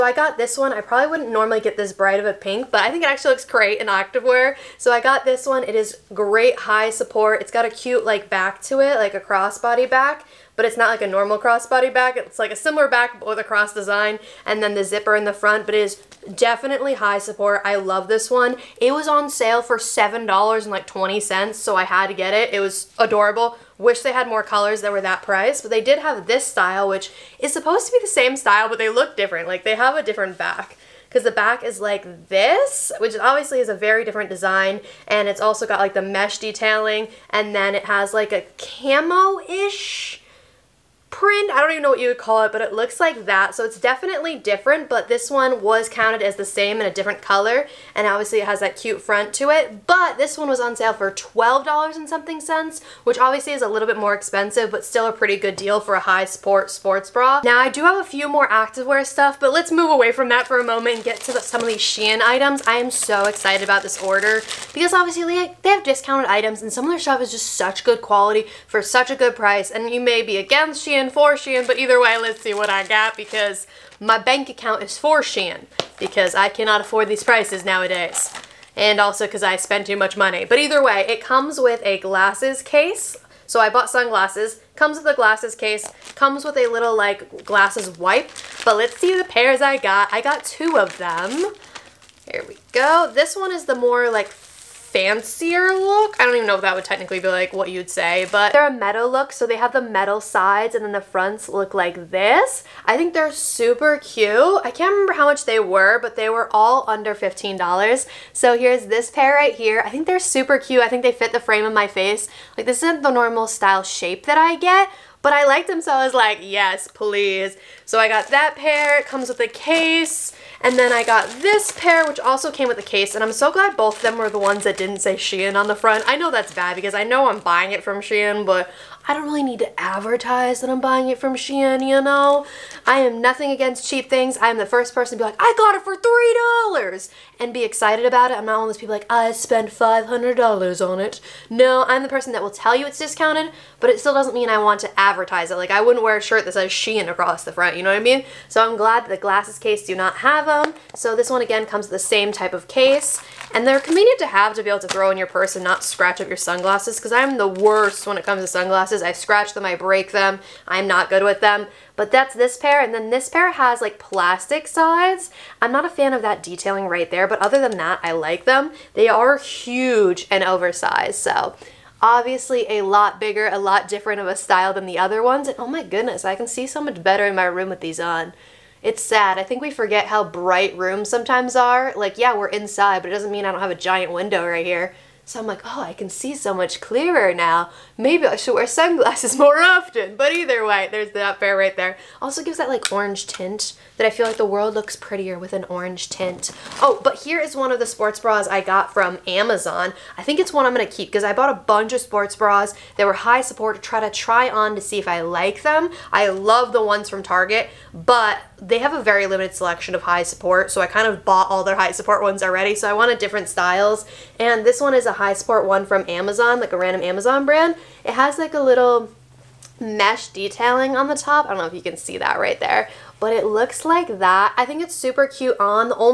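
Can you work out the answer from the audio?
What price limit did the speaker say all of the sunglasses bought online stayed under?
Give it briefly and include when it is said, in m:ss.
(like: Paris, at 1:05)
$15, at 1:47.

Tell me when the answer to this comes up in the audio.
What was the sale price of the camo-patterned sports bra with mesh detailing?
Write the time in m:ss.
0:51.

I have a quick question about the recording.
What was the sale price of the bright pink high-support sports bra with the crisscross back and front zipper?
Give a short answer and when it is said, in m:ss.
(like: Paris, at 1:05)
$7.20, at 0:19.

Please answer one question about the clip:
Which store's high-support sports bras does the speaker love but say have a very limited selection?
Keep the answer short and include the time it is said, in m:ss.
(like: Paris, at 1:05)
Target, at 3:27.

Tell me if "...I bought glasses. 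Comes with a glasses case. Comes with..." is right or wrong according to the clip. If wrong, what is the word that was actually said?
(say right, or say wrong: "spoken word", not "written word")
wrong: "sunglasses", not "glasses".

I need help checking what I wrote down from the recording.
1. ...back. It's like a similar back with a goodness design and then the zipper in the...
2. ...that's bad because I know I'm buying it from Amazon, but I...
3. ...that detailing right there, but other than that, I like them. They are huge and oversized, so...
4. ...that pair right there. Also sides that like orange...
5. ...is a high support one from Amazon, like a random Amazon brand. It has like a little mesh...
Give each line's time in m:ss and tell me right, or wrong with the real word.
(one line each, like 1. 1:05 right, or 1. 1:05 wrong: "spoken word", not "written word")
1. 0:11 wrong: "cross", not "goodness"
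2. 2:06 wrong: "Shein", not "Amazon"
3. 2:46 right
4. 3:11 wrong: "gives", not "sides"
5. 3:34 right.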